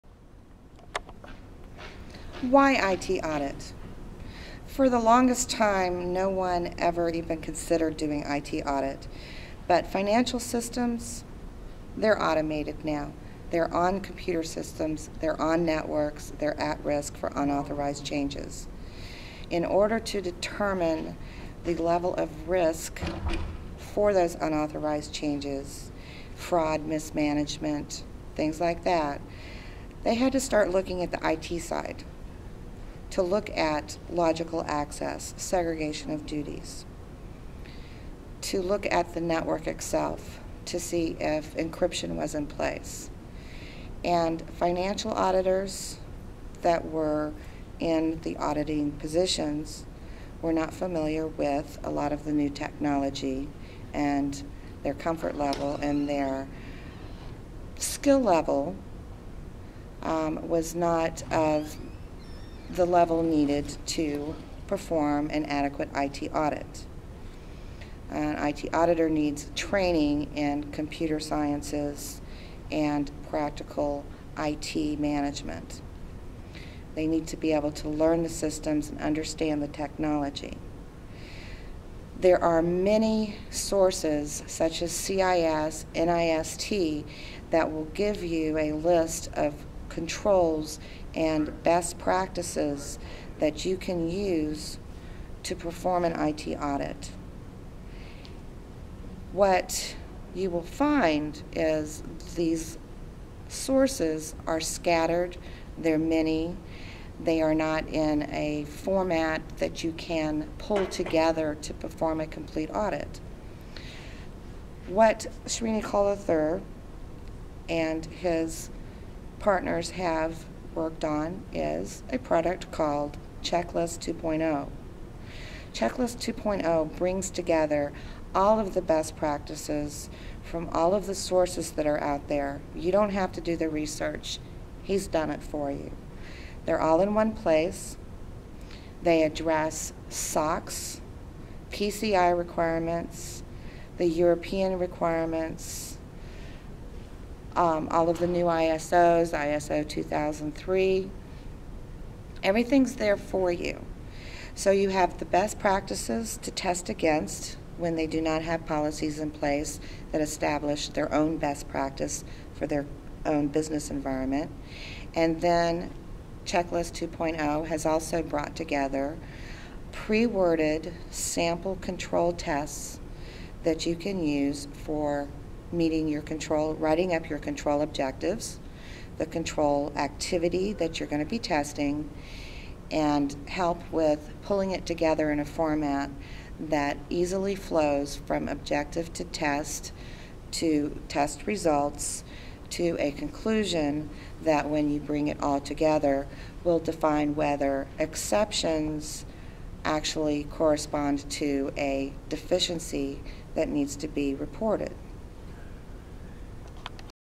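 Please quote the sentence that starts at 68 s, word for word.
An IT auditor needs training in computer sciences and practical IT management.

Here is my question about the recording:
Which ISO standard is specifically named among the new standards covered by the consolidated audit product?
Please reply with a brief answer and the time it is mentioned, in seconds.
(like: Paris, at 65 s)
ISO 2003, at 149 s.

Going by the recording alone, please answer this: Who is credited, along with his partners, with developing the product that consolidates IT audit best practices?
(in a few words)
Srinivas III.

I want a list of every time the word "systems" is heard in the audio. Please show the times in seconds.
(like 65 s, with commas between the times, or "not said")
10 s, 14 s, 78 s.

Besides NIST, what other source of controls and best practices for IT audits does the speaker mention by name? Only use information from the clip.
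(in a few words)
CIS.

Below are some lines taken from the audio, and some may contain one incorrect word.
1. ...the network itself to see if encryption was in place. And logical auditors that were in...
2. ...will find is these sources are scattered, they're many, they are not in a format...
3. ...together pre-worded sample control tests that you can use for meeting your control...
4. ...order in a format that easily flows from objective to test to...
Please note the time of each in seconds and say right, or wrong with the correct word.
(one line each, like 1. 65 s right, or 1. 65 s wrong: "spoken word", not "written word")
1. 39 s wrong: "financial", not "logical"
2. 100 s right
3. 168 s right
4. 184 s wrong: "together", not "order".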